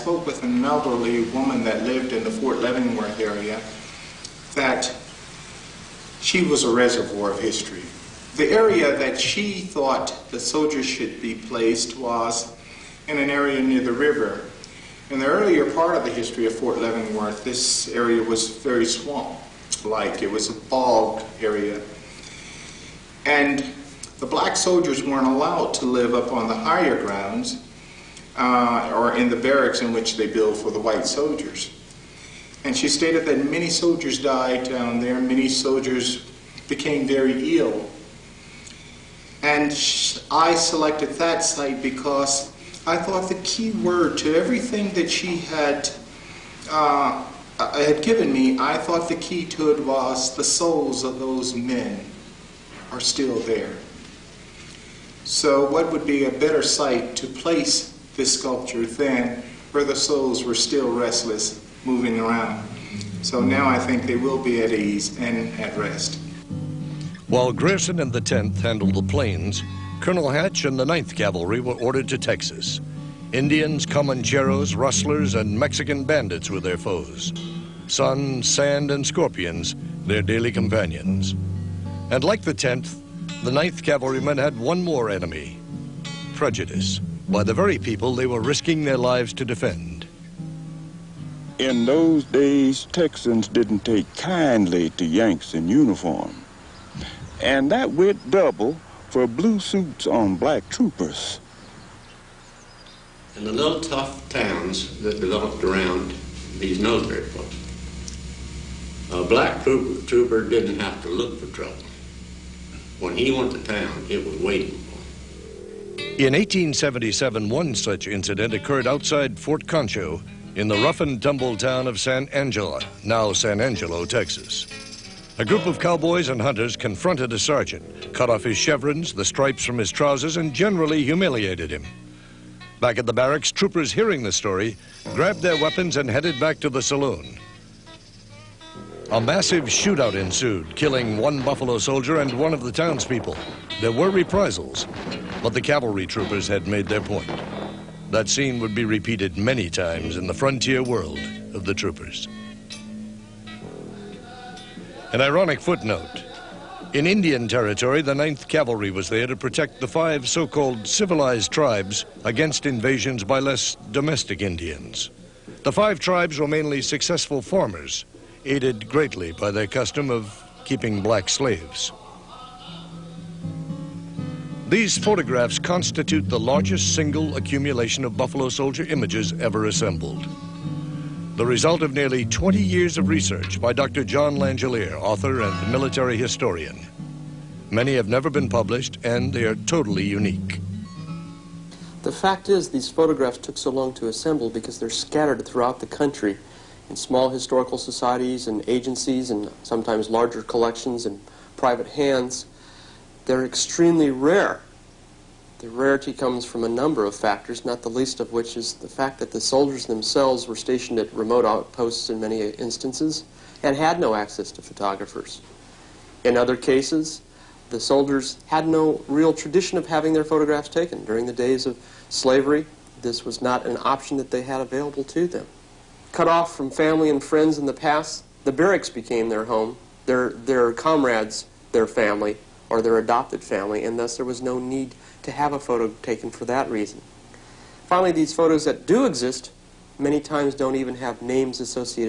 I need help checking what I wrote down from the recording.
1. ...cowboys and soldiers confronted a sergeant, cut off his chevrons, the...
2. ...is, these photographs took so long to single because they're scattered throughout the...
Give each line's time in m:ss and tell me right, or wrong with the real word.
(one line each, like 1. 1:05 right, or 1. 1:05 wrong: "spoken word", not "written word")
1. 2:05 wrong: "hunters", not "soldiers"
2. 3:12 wrong: "assemble", not "single".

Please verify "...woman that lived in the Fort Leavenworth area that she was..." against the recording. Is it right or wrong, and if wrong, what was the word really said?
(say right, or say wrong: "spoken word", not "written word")
right.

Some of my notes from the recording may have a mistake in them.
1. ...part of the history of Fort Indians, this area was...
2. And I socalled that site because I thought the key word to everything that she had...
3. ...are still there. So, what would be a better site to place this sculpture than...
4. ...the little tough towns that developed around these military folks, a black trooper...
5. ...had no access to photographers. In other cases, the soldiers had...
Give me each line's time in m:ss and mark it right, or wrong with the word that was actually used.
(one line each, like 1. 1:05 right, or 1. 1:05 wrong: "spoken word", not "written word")
1. 0:15 wrong: "Leavenworth", not "Indians"
2. 0:39 wrong: "selected", not "socalled"
3. 0:52 right
4. 1:43 right
5. 3:33 right.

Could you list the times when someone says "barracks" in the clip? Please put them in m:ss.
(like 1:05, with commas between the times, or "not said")
0:29, 2:13, 3:48.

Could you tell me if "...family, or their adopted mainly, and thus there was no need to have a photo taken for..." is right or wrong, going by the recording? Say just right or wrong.
wrong.